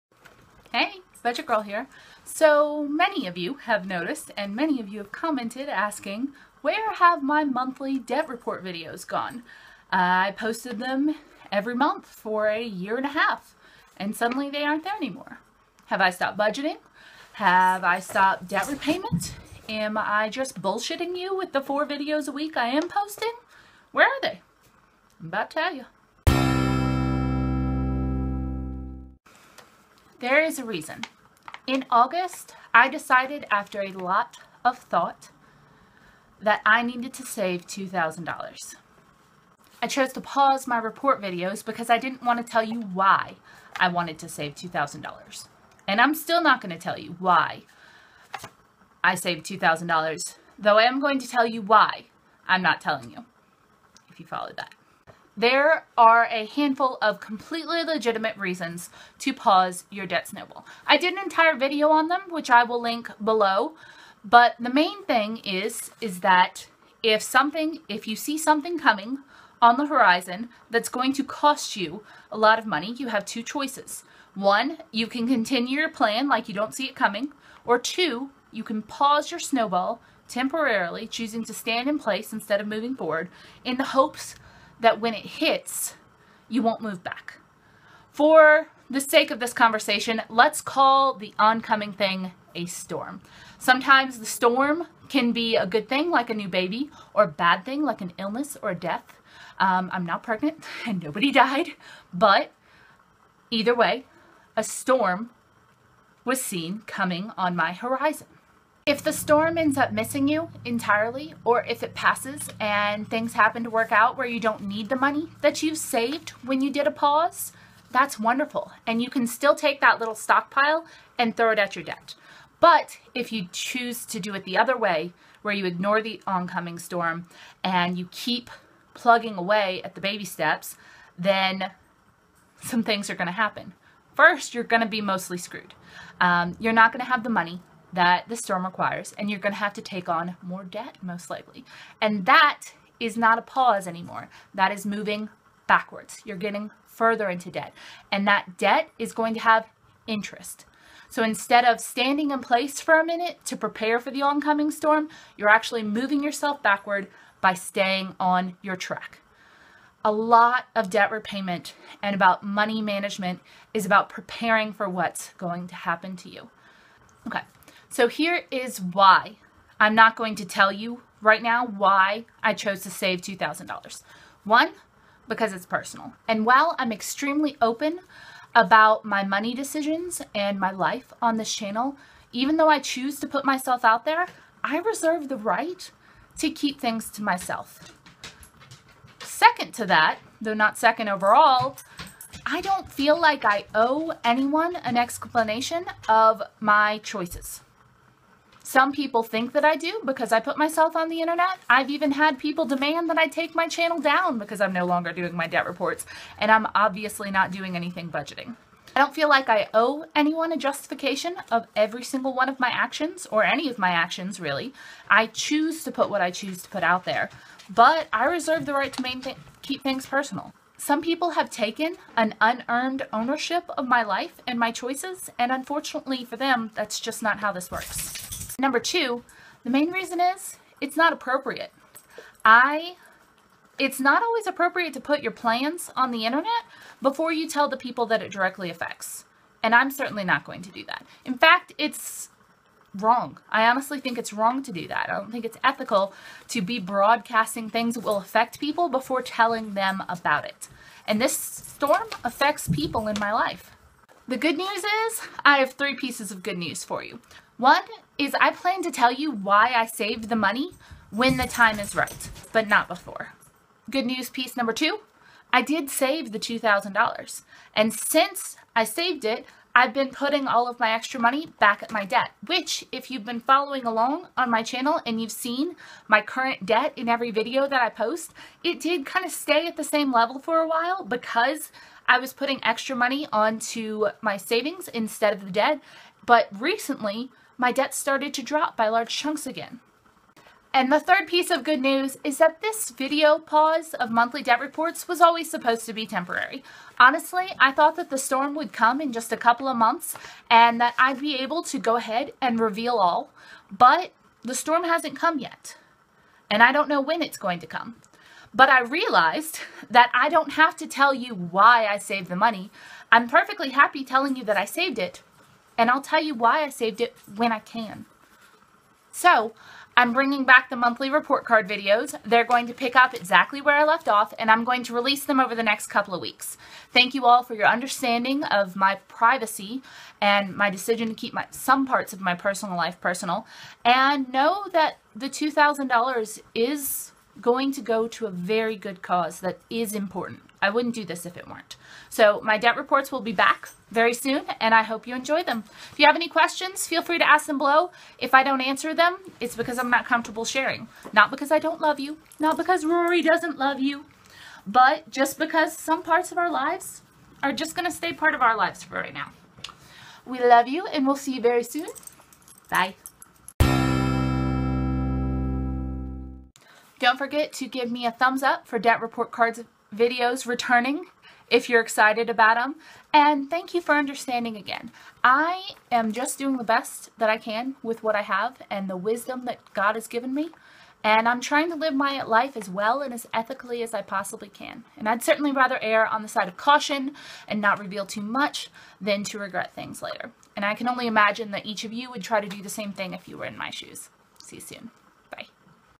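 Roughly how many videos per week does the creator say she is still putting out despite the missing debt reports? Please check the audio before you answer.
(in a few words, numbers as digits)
4.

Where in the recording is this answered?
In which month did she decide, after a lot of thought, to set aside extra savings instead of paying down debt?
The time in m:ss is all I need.
0:31.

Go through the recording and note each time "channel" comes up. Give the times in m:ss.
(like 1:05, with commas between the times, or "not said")
3:01, 3:23, 4:34.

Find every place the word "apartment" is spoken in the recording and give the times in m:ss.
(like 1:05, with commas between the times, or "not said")
not said.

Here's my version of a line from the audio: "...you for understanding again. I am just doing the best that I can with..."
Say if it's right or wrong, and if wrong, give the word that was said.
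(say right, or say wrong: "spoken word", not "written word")
right.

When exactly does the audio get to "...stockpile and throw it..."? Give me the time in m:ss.
2:00.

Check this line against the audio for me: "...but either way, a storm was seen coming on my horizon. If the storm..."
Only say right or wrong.
right.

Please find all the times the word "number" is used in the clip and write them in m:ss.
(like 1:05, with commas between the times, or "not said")
3:48, 4:24.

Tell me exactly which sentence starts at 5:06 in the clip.
And I don't know when it's going to come.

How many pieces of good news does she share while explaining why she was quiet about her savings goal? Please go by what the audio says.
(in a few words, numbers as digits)
3.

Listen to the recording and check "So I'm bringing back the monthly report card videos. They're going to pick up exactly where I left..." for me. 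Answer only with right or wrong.
right.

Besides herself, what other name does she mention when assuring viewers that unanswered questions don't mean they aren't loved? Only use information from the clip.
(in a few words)
Rory.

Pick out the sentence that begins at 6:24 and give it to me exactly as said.
And I'd certainly rather err on the side of caution and not reveal too much than to regret things later.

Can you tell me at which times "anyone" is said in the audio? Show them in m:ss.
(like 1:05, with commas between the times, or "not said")
3:14, 3:30.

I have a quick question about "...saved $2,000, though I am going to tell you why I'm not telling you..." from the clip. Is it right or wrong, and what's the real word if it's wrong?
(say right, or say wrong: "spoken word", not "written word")
right.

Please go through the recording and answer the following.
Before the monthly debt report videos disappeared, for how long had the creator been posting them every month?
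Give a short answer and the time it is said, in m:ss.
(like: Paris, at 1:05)
a year and a half, at 0:12.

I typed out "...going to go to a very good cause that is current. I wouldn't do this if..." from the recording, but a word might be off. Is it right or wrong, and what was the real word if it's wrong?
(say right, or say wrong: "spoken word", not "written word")
wrong: "important", not "current".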